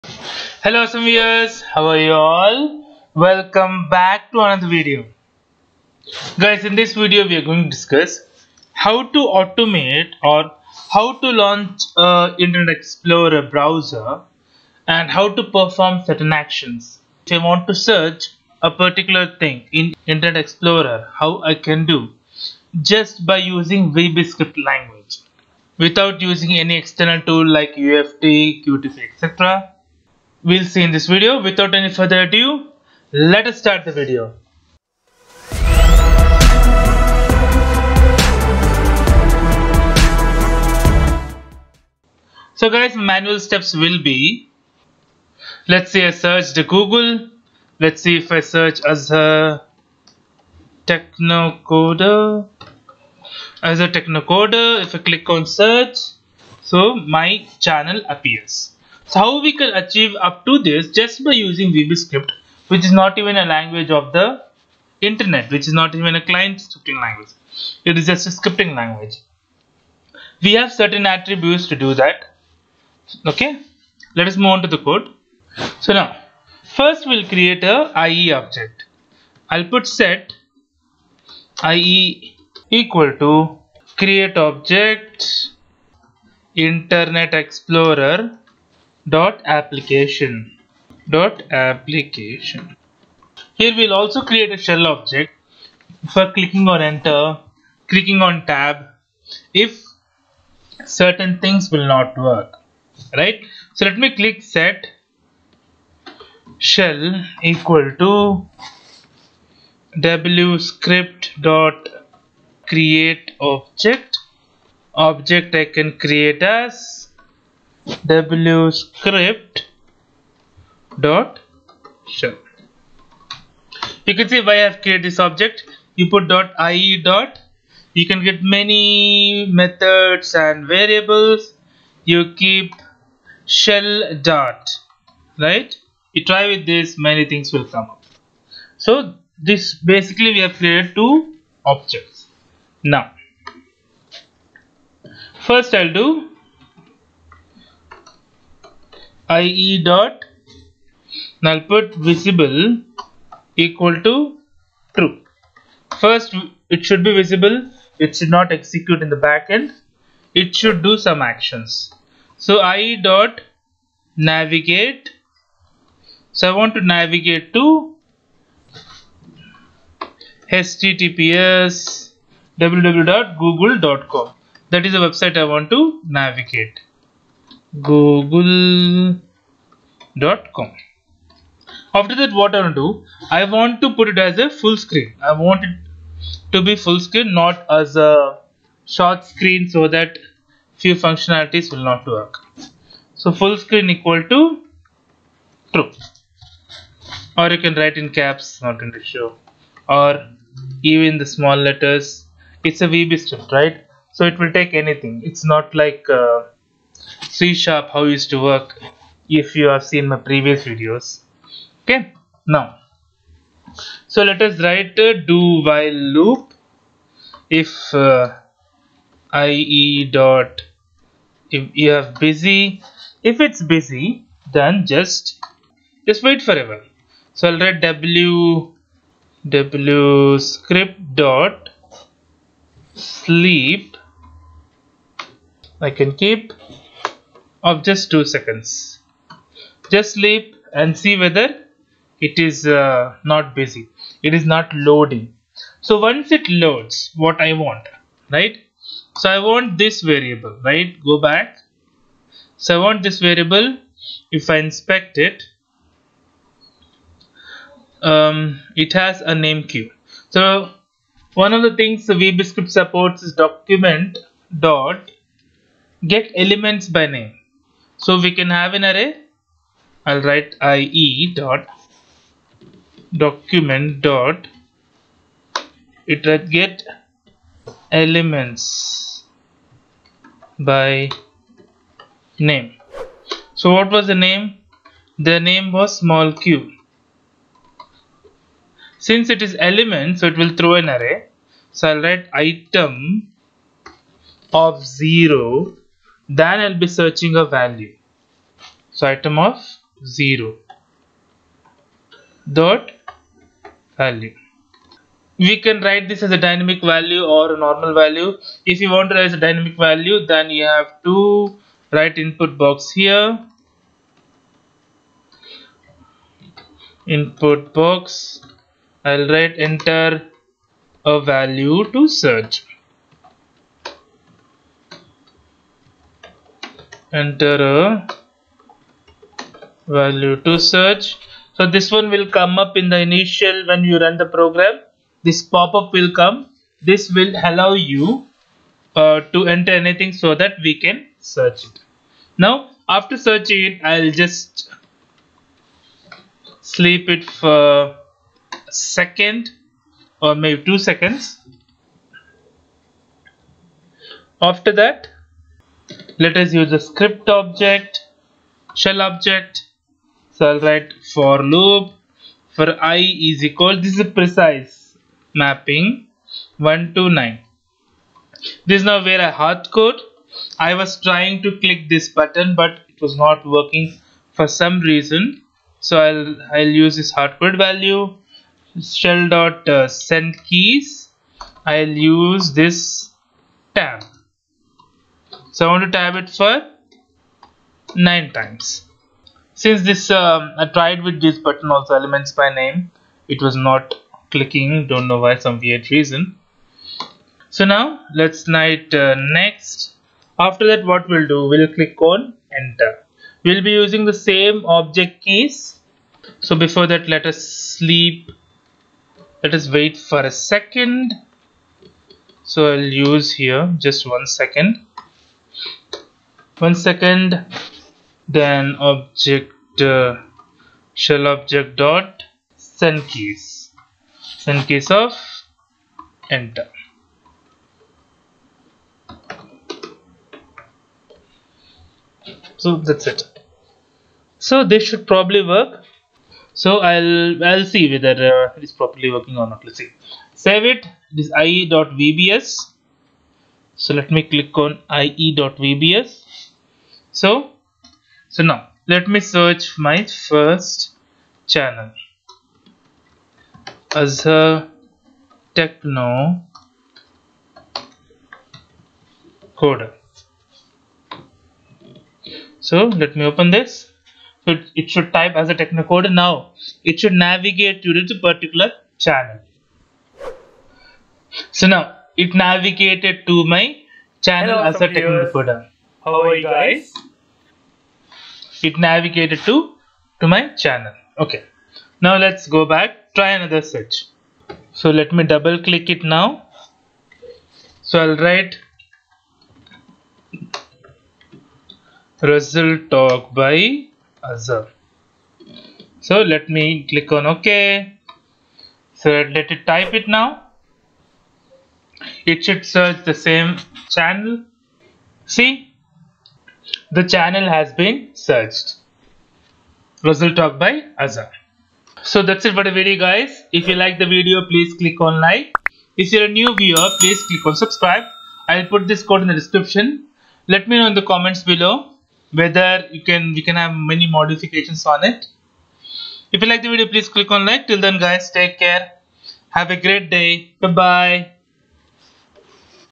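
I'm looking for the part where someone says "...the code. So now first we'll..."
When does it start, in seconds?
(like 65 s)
74 s.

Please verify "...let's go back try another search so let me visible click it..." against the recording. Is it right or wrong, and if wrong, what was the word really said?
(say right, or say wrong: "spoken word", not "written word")
wrong: "double", not "visible".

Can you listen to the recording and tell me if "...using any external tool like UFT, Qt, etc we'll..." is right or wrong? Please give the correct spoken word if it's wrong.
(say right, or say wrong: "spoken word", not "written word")
right.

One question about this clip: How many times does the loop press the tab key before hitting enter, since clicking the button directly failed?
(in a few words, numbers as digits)
9.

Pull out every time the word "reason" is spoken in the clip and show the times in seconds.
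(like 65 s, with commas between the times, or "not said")
374 s, 395 s.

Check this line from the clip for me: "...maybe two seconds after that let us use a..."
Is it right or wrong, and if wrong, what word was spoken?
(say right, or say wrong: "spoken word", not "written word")
right.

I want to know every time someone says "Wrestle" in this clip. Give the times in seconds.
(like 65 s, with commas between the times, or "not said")
492 s, 510 s.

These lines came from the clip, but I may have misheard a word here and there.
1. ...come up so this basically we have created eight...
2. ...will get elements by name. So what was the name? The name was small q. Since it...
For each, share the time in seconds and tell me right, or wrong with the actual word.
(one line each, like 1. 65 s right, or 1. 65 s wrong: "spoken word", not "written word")
1. 137 s wrong: "two", not "eight"
2. 276 s right.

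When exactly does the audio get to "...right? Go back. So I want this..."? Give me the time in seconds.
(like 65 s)
250 s.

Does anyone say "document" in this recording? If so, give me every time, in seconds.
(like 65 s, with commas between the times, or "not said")
263 s, 273 s.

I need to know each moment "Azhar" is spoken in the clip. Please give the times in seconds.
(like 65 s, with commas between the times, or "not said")
48 s, 53 s, 465 s, 494 s, 510 s.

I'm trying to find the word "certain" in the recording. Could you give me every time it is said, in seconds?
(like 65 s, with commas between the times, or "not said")
16 s, 70 s, 100 s.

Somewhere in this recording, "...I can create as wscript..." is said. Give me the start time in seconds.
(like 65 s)
115 s.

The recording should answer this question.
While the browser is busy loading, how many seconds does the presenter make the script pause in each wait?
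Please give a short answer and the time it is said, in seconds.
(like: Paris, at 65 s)
2, at 238 s.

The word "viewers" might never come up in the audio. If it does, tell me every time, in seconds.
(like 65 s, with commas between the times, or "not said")
1 s, 516 s.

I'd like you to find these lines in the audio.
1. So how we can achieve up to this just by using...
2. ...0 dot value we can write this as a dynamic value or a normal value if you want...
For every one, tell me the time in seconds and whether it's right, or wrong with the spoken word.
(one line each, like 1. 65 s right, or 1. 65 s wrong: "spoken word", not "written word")
1. 59 s right
2. 300 s right.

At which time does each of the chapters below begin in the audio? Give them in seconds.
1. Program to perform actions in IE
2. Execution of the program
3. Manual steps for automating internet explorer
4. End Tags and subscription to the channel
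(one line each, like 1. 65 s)
1. 75 s
2. 443 s
3. 42 s
4. 511 s.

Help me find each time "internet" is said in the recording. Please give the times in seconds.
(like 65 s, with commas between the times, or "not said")
12 s, 20 s, 65 s, 86 s.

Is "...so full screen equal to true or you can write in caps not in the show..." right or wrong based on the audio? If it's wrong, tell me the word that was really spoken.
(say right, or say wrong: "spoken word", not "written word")
right.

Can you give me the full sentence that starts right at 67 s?
It is just a scripting language.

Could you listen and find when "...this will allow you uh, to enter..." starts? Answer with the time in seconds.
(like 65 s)
336 s.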